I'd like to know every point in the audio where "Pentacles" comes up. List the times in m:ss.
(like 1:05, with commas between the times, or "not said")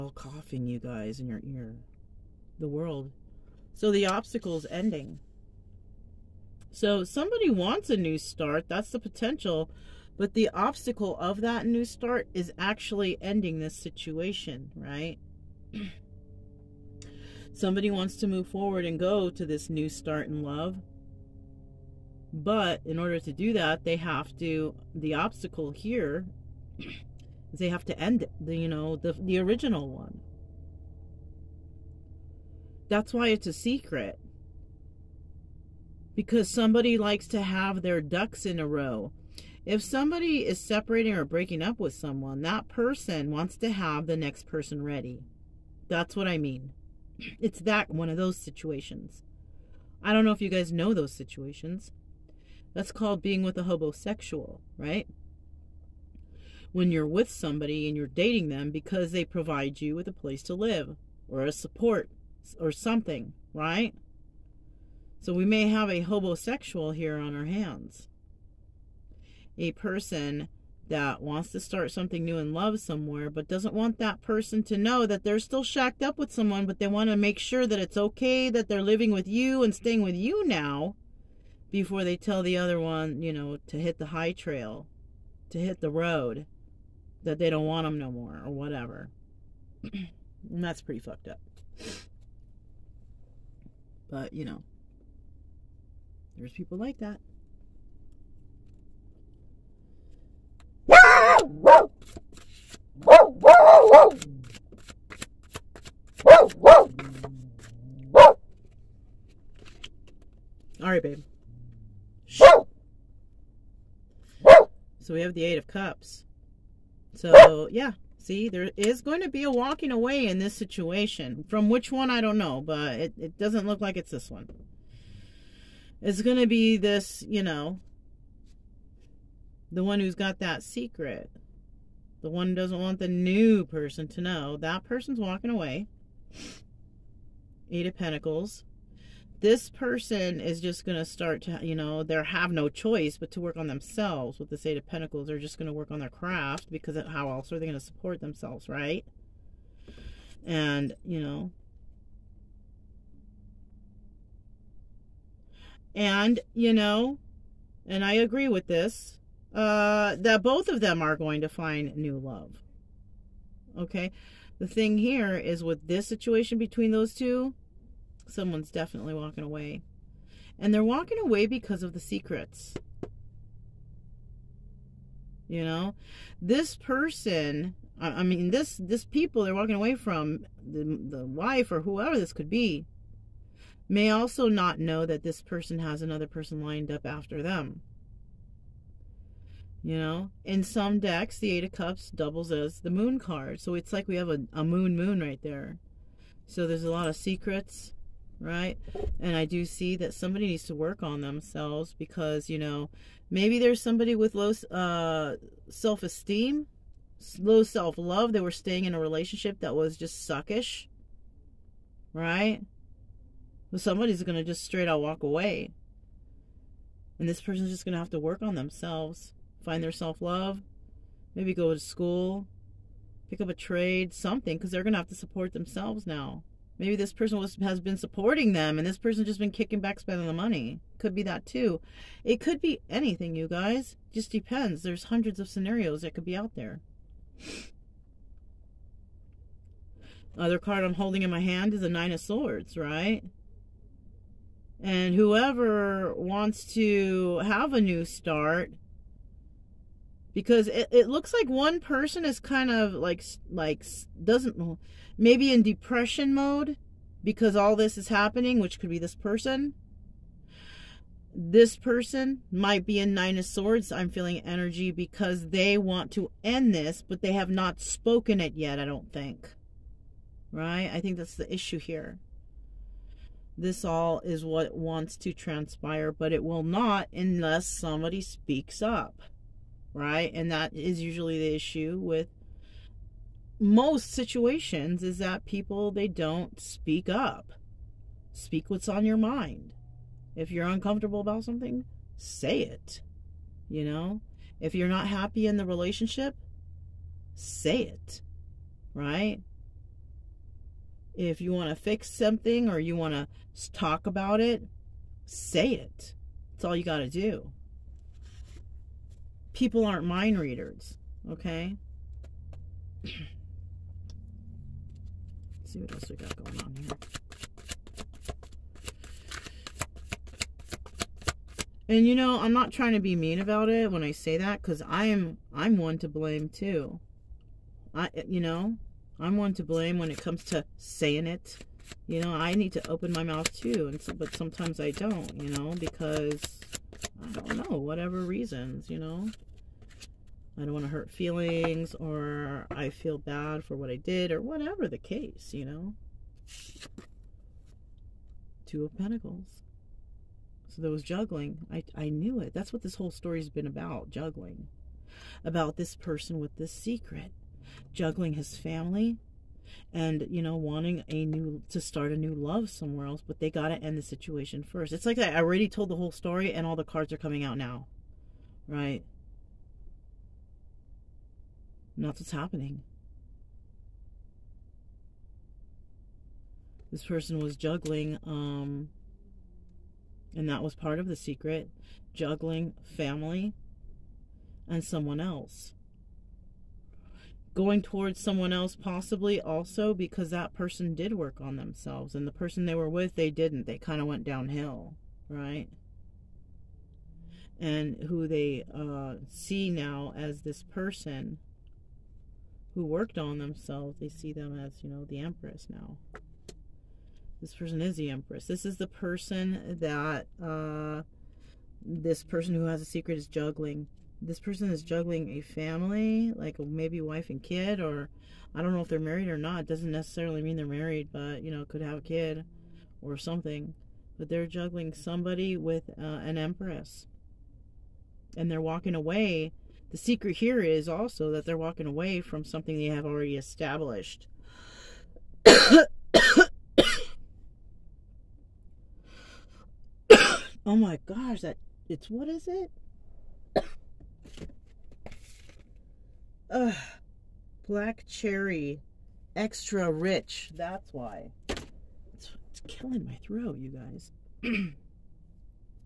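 2:17, 2:24, 5:48.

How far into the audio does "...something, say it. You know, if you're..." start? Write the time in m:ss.
4:51.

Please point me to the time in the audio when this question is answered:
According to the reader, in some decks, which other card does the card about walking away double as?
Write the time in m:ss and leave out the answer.
3:12.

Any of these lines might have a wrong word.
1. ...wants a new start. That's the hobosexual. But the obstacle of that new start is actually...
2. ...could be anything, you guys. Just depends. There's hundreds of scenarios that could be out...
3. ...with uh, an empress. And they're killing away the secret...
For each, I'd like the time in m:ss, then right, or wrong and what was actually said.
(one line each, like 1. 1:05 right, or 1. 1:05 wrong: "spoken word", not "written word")
1. 0:07 wrong: "potential", not "hobosexual"
2. 3:52 right
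3. 7:05 wrong: "walking", not "killing".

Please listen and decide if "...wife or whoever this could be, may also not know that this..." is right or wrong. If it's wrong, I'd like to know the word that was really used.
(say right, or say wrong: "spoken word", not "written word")
right.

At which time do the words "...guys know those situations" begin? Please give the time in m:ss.
0:50.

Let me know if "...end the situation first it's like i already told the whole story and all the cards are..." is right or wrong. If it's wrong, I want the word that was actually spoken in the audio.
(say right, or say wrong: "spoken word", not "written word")
right.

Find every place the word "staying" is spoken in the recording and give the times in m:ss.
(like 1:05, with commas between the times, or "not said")
1:19, 3:28.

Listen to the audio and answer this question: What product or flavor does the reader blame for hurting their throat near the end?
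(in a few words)
black cherry, extra rich.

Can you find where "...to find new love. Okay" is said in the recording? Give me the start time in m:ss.
2:41.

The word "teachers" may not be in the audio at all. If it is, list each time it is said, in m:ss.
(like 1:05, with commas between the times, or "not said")
not said.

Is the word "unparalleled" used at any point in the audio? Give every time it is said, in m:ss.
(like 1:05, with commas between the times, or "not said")
not said.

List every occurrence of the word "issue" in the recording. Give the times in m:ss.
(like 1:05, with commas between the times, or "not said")
4:31, 4:41.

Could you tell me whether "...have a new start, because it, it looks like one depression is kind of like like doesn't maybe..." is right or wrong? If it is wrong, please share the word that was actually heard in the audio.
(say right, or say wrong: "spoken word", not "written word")
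wrong: "person", not "depression".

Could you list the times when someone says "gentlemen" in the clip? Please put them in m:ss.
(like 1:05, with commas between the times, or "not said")
not said.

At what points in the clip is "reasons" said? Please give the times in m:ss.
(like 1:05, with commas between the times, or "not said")
5:38.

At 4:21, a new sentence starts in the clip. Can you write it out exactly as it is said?
This person might be in Nine of Swords.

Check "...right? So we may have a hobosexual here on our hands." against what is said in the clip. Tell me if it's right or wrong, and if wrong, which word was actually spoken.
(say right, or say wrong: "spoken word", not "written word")
right.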